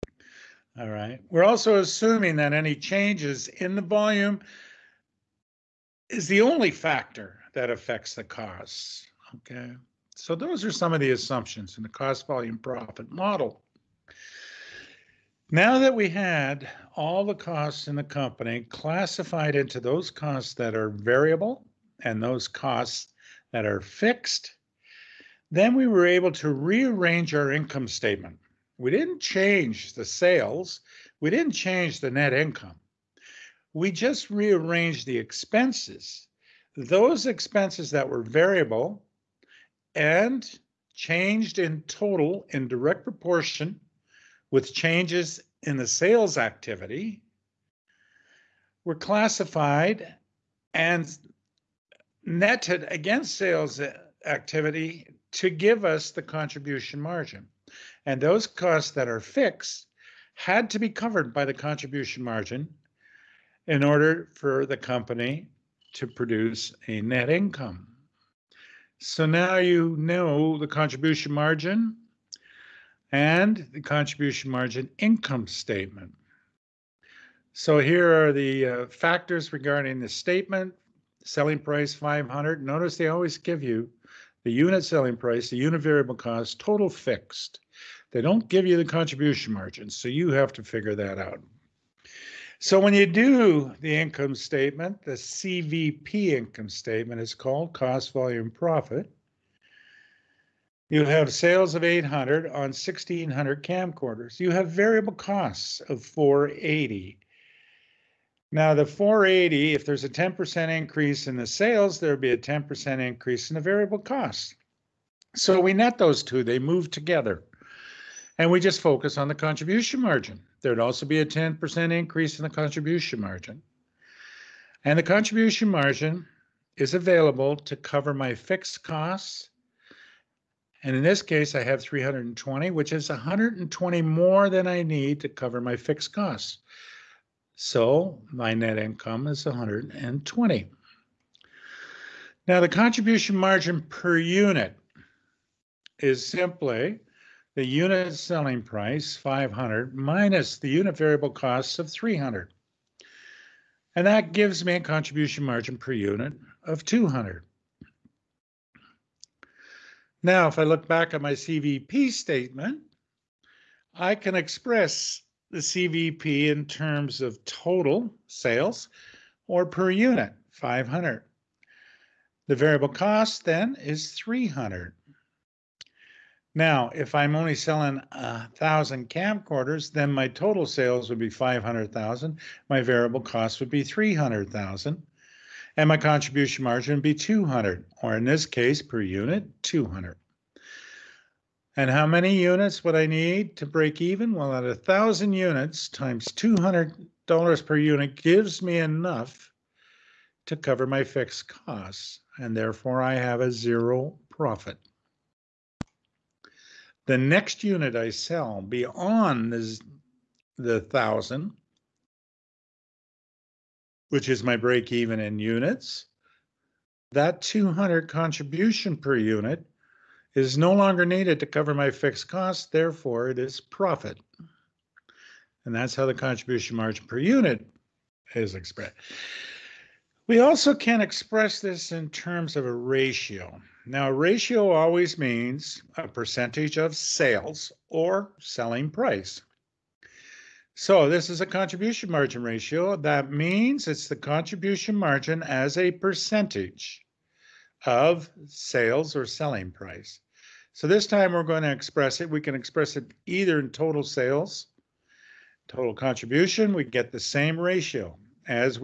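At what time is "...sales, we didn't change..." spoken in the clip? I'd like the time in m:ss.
0:30.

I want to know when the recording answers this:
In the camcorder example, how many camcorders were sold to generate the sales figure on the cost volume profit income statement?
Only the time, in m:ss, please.
1:42.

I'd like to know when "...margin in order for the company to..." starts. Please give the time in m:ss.
1:02.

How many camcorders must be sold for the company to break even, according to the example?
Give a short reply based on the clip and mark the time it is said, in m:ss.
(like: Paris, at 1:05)
1,000, at 3:14.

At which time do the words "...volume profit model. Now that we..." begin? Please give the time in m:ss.
0:12.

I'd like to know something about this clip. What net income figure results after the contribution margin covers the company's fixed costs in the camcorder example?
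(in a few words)
120.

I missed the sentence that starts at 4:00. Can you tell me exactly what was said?
So this is a contribution margin ratio.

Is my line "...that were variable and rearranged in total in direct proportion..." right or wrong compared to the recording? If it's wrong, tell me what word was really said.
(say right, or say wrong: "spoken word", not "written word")
wrong: "changed", not "rearranged".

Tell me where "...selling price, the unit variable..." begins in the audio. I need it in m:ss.
1:24.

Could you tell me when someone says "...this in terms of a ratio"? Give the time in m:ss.
3:51.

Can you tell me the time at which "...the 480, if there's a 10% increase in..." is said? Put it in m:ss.
1:48.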